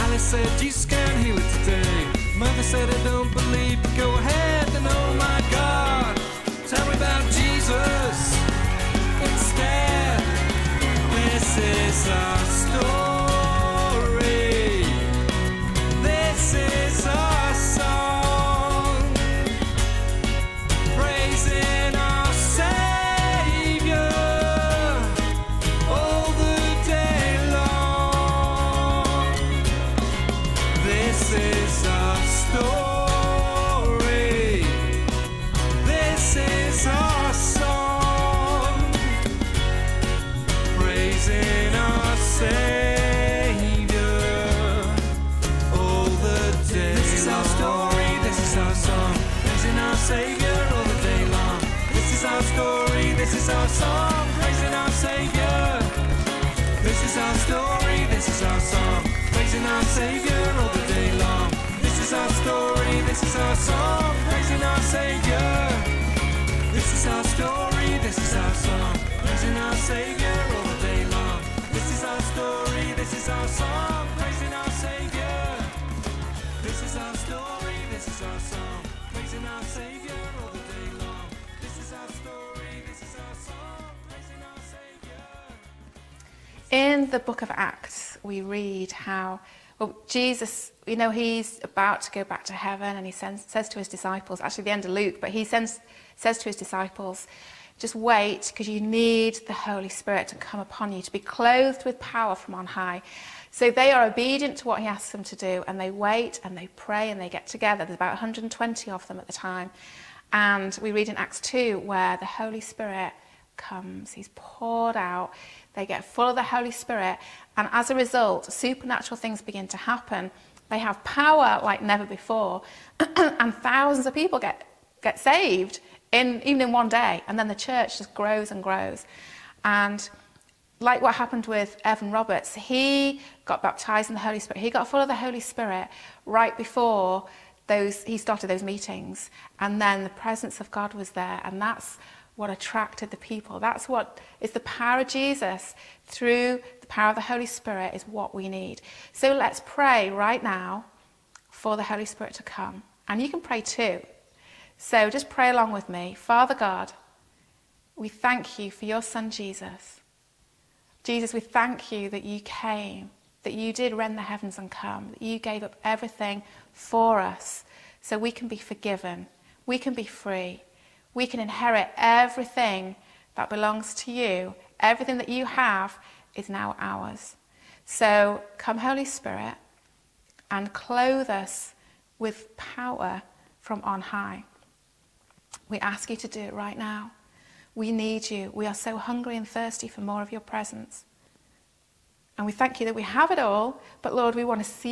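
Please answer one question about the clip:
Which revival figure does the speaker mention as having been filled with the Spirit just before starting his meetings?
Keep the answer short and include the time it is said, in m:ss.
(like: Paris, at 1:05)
Evan Roberts, at 2:11.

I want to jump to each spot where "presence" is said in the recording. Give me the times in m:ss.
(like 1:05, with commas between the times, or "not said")
2:20, 3:10.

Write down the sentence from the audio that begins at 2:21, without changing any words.
And that's what attracted the people.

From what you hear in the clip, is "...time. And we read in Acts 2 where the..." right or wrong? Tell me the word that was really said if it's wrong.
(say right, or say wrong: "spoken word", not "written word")
right.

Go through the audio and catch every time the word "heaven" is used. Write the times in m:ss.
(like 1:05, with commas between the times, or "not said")
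1:32, 2:44.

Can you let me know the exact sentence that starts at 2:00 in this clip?
They have power like never before.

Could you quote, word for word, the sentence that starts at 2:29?
So let's pray right now for the Holy Spirit to come.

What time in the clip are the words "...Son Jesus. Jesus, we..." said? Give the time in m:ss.
2:39.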